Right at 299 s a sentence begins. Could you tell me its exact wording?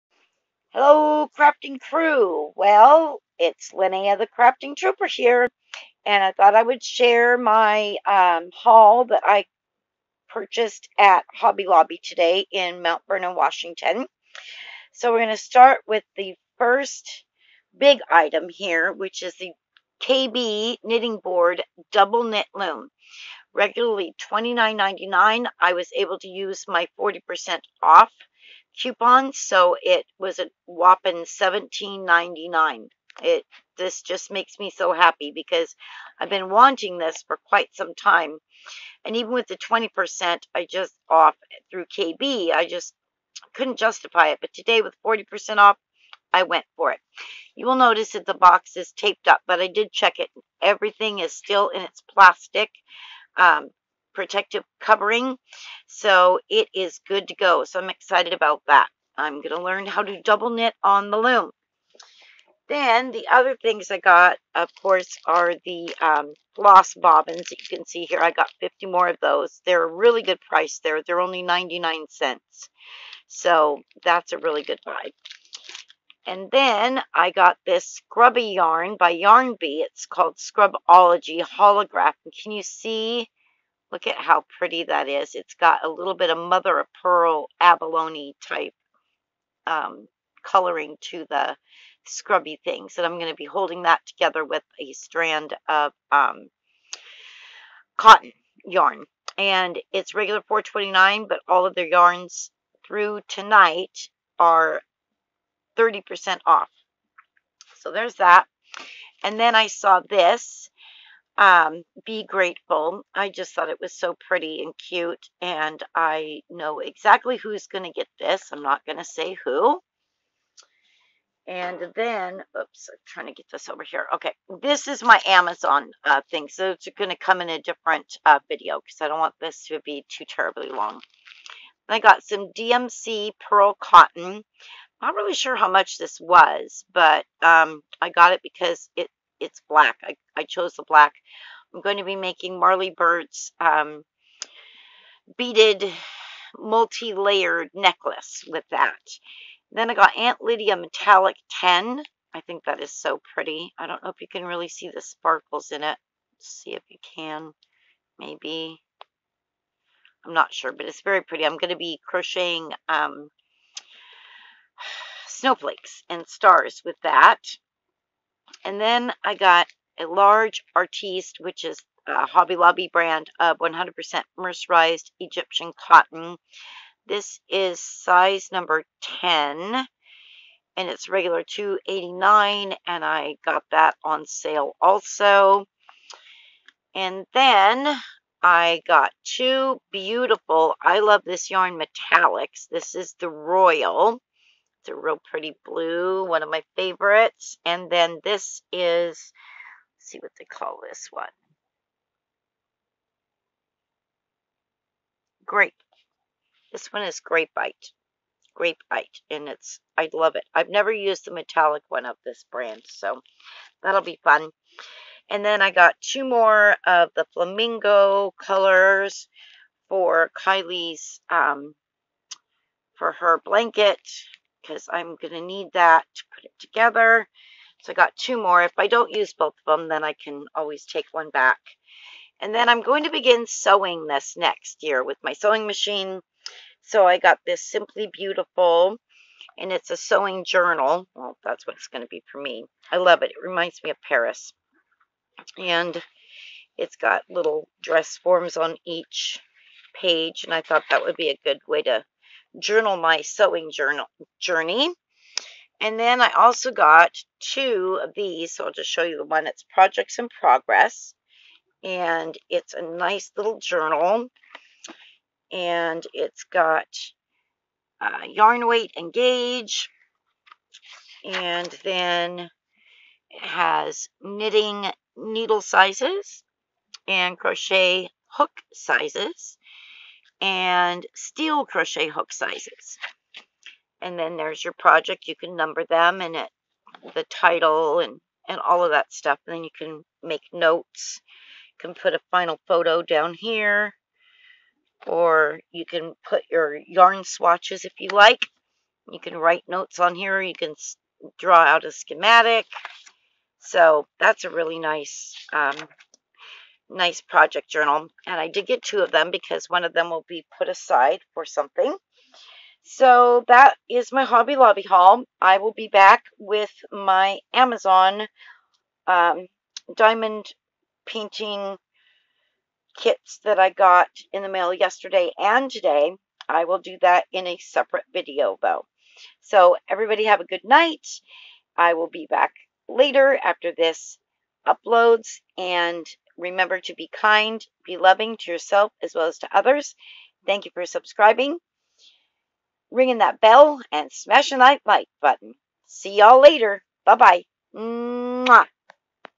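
You can write notes on here.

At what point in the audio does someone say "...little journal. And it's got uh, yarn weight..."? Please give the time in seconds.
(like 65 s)
263 s.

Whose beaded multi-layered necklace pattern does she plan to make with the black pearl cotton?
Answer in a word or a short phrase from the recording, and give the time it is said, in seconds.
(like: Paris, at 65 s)
Marley Bird, at 142 s.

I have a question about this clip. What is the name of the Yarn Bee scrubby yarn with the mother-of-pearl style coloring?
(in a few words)
Scrubology Holograph.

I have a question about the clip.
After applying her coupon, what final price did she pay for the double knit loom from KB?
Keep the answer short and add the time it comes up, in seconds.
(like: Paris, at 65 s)
$17.99, at 31 s.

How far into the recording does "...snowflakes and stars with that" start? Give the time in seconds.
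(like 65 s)
165 s.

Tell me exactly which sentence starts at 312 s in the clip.
So that is my Hobby Lobby haul.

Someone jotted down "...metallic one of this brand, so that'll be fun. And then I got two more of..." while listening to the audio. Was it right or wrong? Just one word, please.
right.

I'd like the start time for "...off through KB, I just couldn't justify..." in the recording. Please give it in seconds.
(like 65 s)
41 s.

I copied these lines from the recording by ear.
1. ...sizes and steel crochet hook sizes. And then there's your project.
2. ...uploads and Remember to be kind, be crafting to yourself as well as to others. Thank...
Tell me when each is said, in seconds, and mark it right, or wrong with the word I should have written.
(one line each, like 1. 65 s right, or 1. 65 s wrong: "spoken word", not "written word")
1. 278 s right
2. 334 s wrong: "loving", not "crafting".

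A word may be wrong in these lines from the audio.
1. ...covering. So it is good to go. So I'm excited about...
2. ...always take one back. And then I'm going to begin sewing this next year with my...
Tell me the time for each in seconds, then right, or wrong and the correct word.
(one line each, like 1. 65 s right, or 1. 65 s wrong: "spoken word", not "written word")
1. 54 s right
2. 230 s right.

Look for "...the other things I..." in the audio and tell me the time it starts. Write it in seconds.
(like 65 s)
63 s.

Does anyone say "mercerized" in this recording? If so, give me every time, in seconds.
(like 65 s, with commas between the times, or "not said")
174 s.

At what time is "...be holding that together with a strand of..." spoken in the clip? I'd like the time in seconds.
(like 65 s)
93 s.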